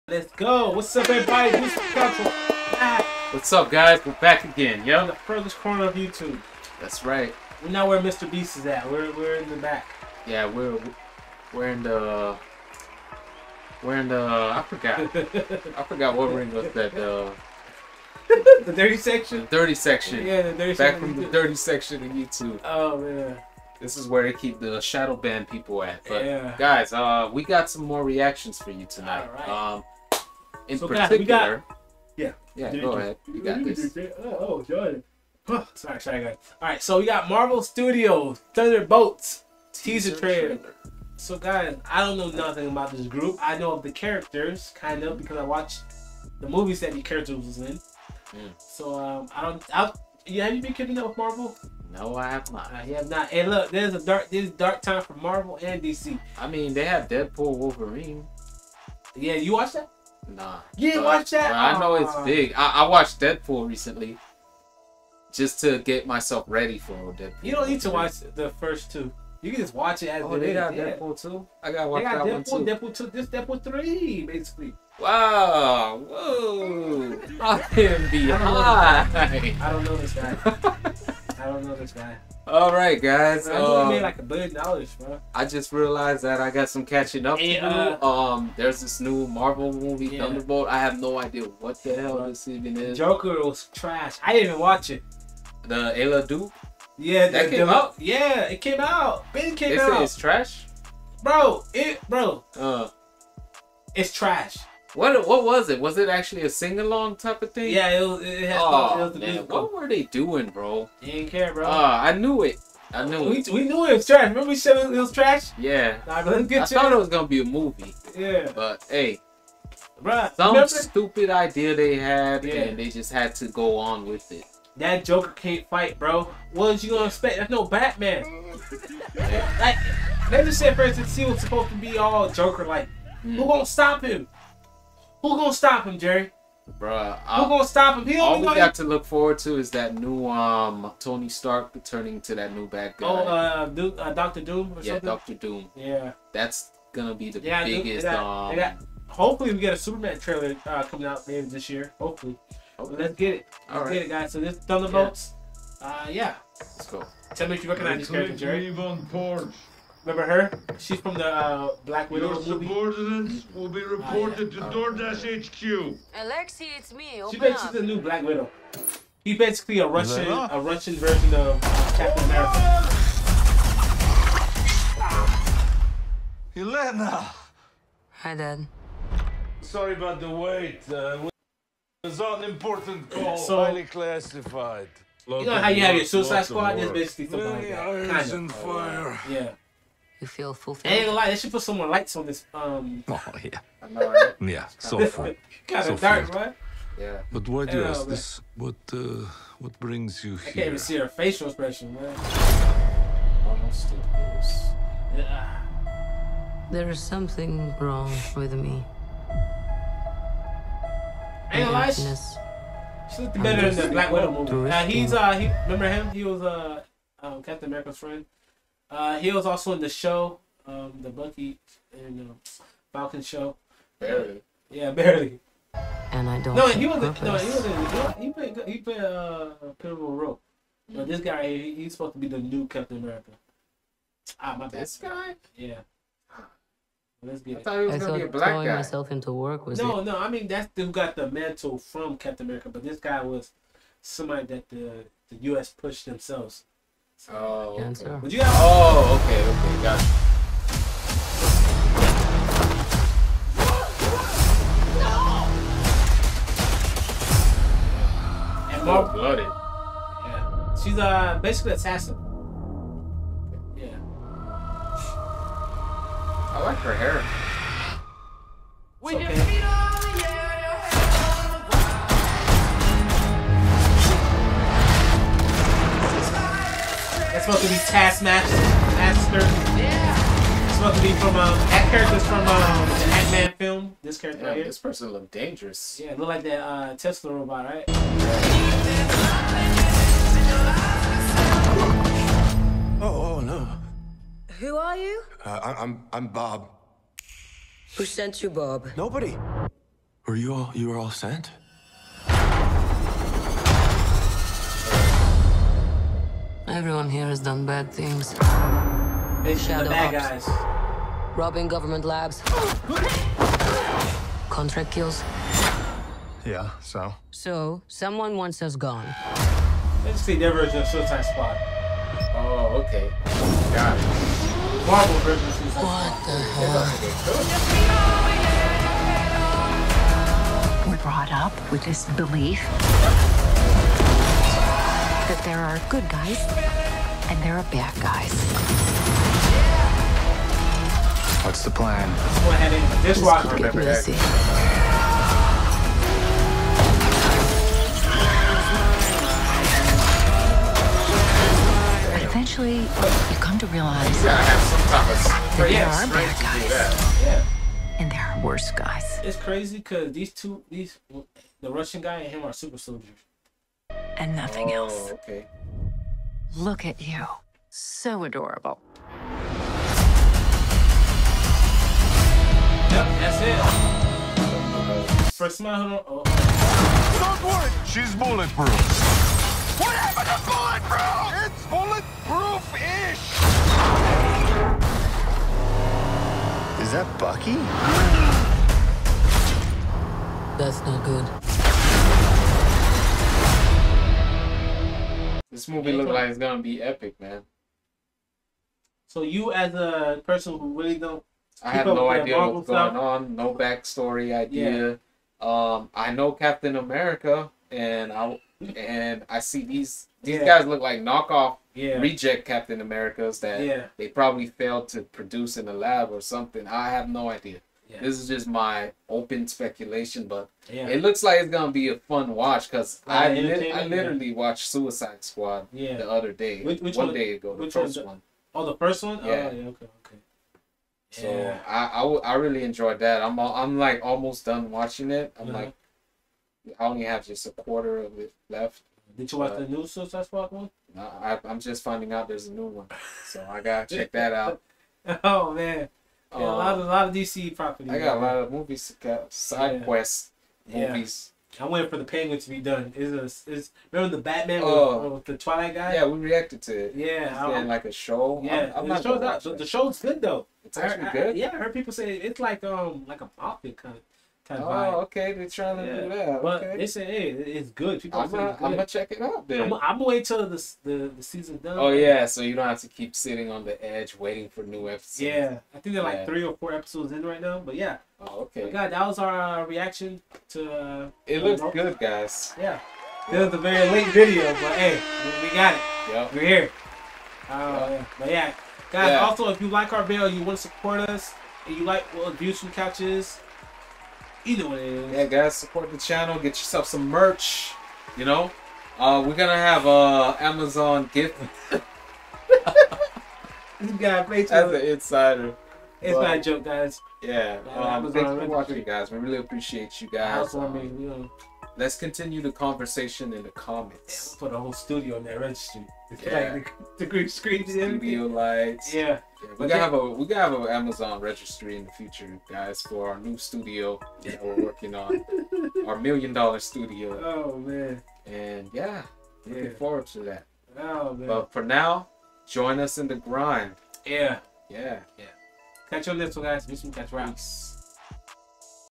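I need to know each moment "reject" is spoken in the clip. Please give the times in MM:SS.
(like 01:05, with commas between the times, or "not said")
06:51.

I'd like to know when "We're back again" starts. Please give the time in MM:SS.
00:04.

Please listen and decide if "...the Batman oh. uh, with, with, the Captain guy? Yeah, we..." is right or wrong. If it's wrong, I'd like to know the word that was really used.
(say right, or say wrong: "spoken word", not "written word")
wrong: "Twilight", not "Captain".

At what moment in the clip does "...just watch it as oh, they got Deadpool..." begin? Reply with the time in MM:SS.
01:09.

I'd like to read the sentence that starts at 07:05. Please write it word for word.
the other day, which, which one, one, day ago, the first the, one.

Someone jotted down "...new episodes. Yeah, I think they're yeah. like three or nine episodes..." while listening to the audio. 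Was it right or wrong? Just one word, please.
wrong.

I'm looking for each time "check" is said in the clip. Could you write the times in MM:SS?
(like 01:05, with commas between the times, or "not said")
07:23, 07:48.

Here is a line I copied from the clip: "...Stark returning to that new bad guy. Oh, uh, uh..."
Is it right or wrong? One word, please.
right.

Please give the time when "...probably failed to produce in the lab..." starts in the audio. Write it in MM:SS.
06:54.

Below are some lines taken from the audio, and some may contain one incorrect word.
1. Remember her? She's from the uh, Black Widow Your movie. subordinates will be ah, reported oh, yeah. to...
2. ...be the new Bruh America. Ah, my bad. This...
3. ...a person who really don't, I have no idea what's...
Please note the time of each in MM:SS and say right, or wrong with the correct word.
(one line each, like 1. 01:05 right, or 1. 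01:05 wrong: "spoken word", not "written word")
1. 02:40 right
2. 03:52 wrong: "Captain", not "Bruh"
3. 06:39 right.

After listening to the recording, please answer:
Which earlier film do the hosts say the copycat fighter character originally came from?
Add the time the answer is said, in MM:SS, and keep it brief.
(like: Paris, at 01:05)
Ant-Man, at 04:42.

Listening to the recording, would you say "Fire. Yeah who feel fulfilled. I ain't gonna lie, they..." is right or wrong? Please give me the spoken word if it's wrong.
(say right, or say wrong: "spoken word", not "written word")
right.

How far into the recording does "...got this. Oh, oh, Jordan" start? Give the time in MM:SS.
00:33.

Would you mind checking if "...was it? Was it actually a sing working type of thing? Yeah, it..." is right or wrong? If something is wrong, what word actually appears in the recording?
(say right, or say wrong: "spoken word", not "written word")
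wrong: "along", not "working".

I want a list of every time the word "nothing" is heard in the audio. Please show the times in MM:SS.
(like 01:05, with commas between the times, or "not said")
00:42, 06:04.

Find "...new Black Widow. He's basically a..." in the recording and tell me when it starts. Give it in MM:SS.
02:47.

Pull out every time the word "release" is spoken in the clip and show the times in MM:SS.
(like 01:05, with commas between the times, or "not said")
not said.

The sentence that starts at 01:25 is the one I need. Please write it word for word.
I just realized that I got some catching up hey, to do.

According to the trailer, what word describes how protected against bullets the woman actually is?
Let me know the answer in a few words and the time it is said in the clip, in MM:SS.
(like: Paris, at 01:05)
bulletproof-ish, at 06:21.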